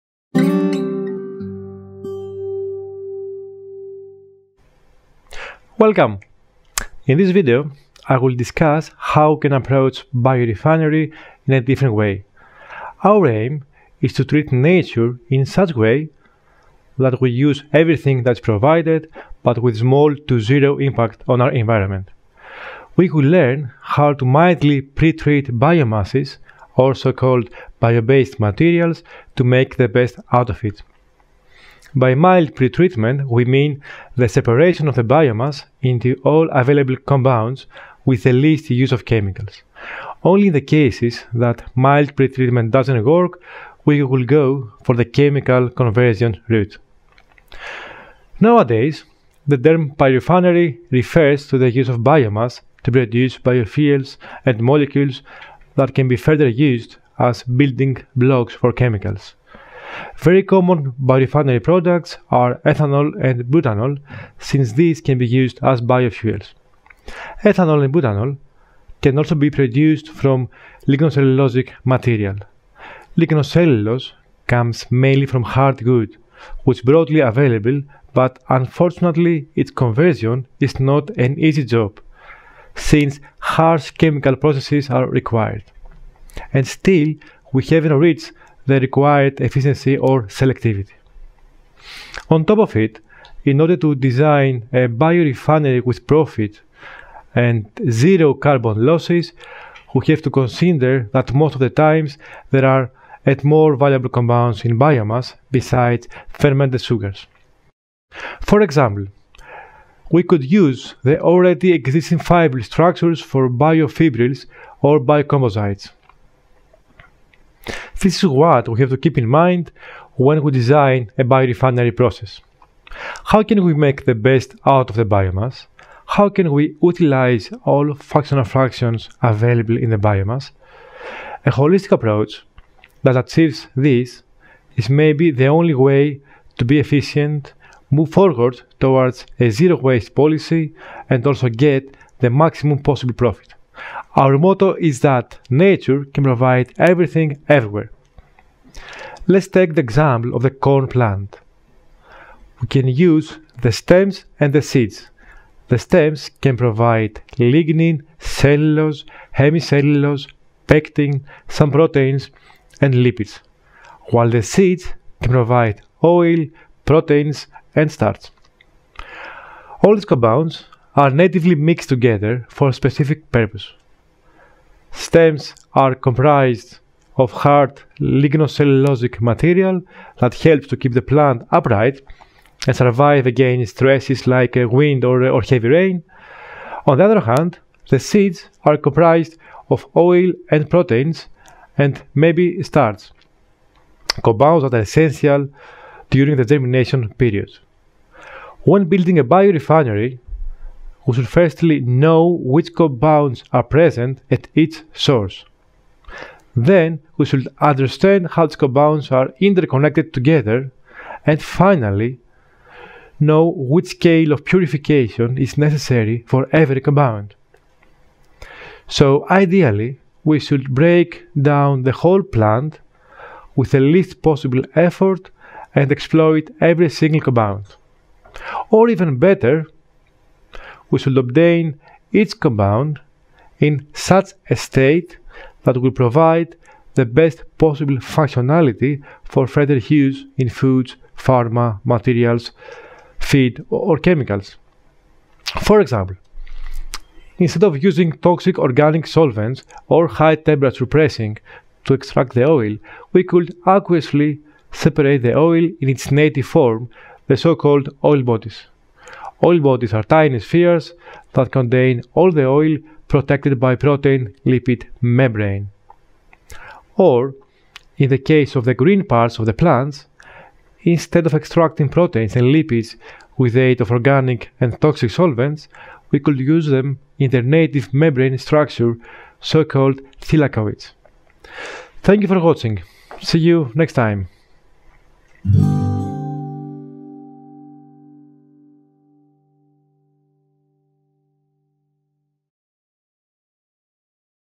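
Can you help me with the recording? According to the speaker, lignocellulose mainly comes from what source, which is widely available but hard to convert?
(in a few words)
Hard wood.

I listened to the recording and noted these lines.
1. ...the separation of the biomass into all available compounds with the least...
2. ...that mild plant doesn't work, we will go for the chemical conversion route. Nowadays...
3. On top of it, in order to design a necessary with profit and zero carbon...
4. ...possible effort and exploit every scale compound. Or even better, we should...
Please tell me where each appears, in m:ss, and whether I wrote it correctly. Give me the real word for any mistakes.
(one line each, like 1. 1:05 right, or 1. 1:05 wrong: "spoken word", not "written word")
1. 0:34 right
2. 0:41 wrong: "pretreatment", not "plant"
3. 1:32 wrong: "biorefinery", not "necessary"
4. 3:44 wrong: "single", not "scale".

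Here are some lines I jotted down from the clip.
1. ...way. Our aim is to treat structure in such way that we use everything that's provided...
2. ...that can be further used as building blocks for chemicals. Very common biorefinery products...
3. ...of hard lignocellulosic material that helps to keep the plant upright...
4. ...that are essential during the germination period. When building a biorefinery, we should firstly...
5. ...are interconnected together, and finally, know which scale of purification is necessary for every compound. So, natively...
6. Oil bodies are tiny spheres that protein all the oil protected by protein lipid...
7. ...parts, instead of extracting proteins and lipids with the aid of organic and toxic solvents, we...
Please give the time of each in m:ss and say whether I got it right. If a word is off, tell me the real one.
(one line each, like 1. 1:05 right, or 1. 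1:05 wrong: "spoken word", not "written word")
1. 0:11 wrong: "nature", not "structure"
2. 0:55 right
3. 2:57 right
4. 3:14 right
5. 3:29 wrong: "ideally", not "natively"
6. 4:19 wrong: "contain", not "protein"
7. 4:29 wrong: "plants", not "parts".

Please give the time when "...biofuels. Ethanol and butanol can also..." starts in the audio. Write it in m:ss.
1:05.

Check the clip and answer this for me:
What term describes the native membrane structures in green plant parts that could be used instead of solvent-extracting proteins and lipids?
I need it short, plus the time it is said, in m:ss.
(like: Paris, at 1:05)
Thylakoids, at 4:40.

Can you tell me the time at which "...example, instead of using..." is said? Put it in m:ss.
4:05.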